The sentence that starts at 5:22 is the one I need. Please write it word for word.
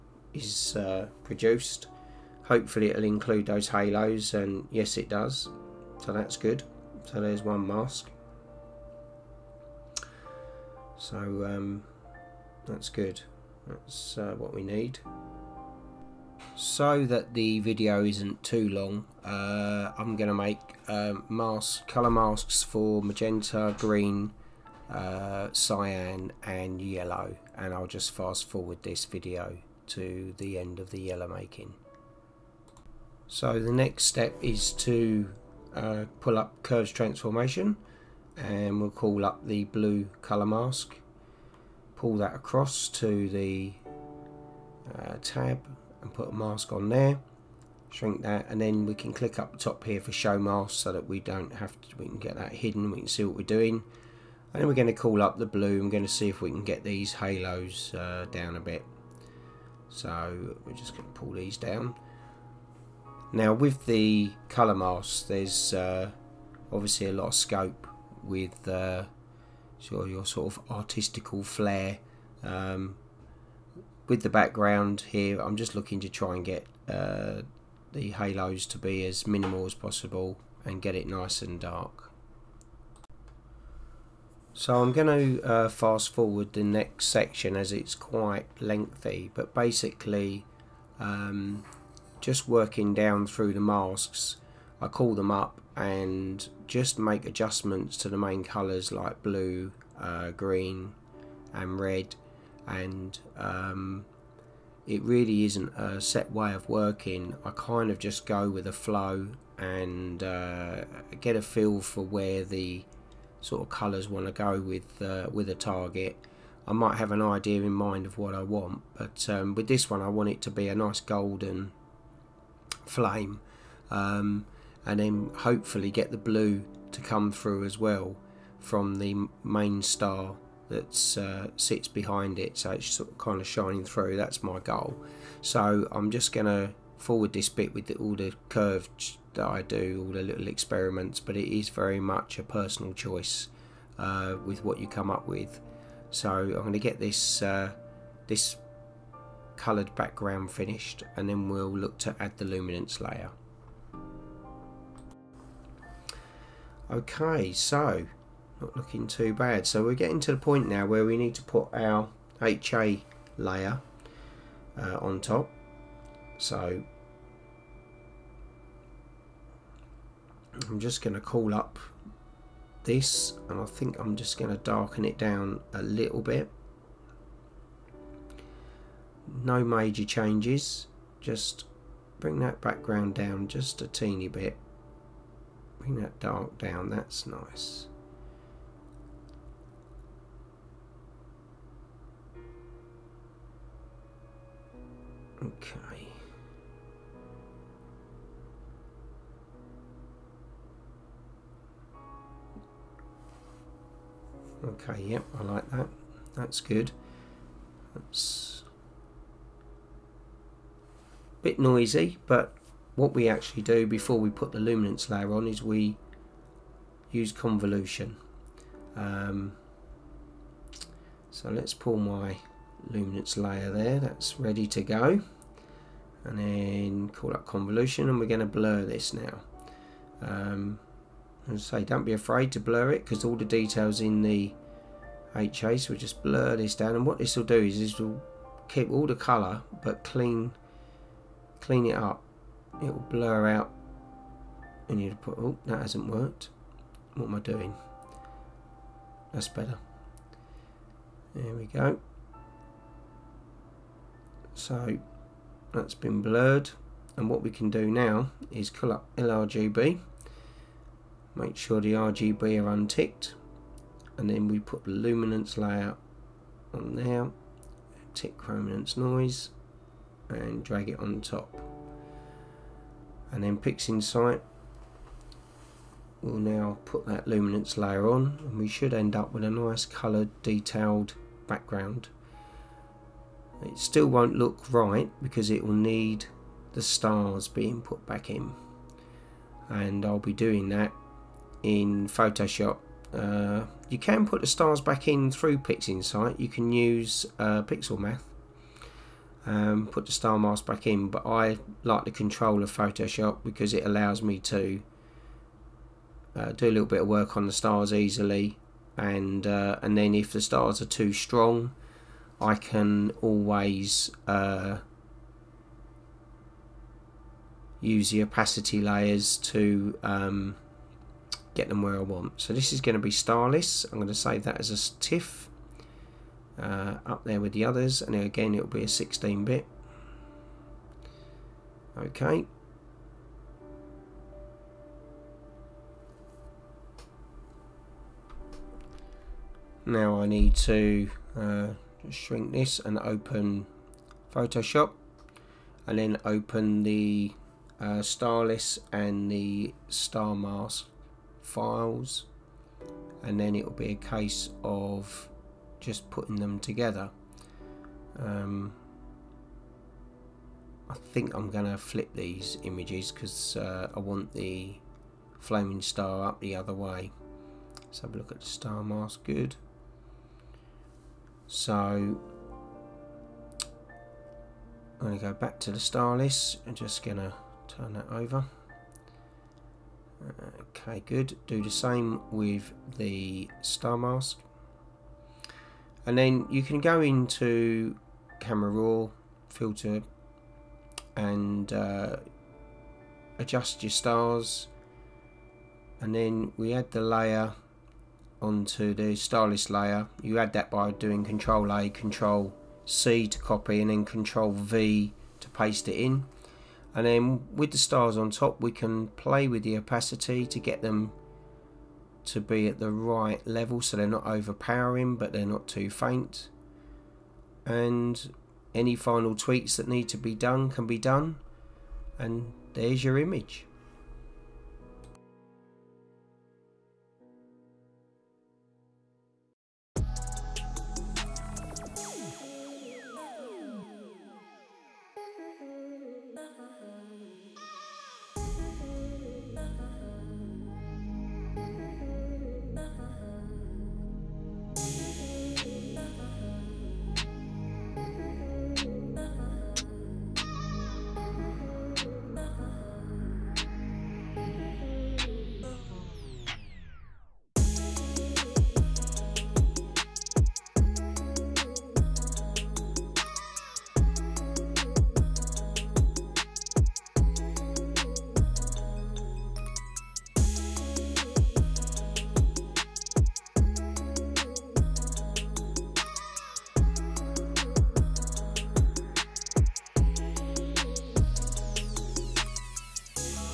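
So this is going to be starless.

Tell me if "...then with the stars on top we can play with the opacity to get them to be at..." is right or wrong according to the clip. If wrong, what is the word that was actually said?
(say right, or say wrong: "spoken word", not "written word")
right.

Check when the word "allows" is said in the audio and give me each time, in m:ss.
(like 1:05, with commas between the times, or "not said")
5:03.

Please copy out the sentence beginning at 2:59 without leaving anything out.
No major changes, just bring that background down just a teeny bit.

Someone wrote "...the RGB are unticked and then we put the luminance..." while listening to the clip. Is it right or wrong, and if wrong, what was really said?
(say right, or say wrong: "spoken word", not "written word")
right.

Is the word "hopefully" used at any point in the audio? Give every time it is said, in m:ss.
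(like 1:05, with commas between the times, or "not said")
0:02, 2:05.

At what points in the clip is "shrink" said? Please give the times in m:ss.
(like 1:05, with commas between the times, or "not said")
0:47, 5:42.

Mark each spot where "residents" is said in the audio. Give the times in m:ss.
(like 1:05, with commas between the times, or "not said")
not said.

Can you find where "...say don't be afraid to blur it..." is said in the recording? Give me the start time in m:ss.
3:51.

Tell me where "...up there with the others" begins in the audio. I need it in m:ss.
5:27.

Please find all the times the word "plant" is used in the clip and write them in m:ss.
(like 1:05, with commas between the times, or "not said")
not said.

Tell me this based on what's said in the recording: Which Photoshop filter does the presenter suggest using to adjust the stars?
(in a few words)
Camera Raw.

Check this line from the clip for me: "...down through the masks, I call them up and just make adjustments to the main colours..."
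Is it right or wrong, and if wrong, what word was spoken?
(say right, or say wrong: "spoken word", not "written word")
right.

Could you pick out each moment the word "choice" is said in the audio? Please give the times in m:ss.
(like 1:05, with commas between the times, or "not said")
2:22.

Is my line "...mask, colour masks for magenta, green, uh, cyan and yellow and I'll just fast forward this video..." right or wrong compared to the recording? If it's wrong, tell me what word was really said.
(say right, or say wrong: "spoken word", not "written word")
right.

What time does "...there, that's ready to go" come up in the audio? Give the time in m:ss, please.
3:43.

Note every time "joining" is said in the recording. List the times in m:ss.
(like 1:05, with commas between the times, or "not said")
not said.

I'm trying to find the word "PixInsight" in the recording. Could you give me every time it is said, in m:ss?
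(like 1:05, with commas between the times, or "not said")
4:33, 4:55.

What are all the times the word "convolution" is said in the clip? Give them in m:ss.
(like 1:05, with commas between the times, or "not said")
3:37, 3:47.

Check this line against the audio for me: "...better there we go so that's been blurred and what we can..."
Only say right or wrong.
right.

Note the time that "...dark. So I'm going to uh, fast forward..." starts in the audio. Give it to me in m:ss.
1:21.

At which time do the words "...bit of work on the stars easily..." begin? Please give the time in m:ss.
5:06.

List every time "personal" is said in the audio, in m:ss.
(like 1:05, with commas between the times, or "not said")
2:22.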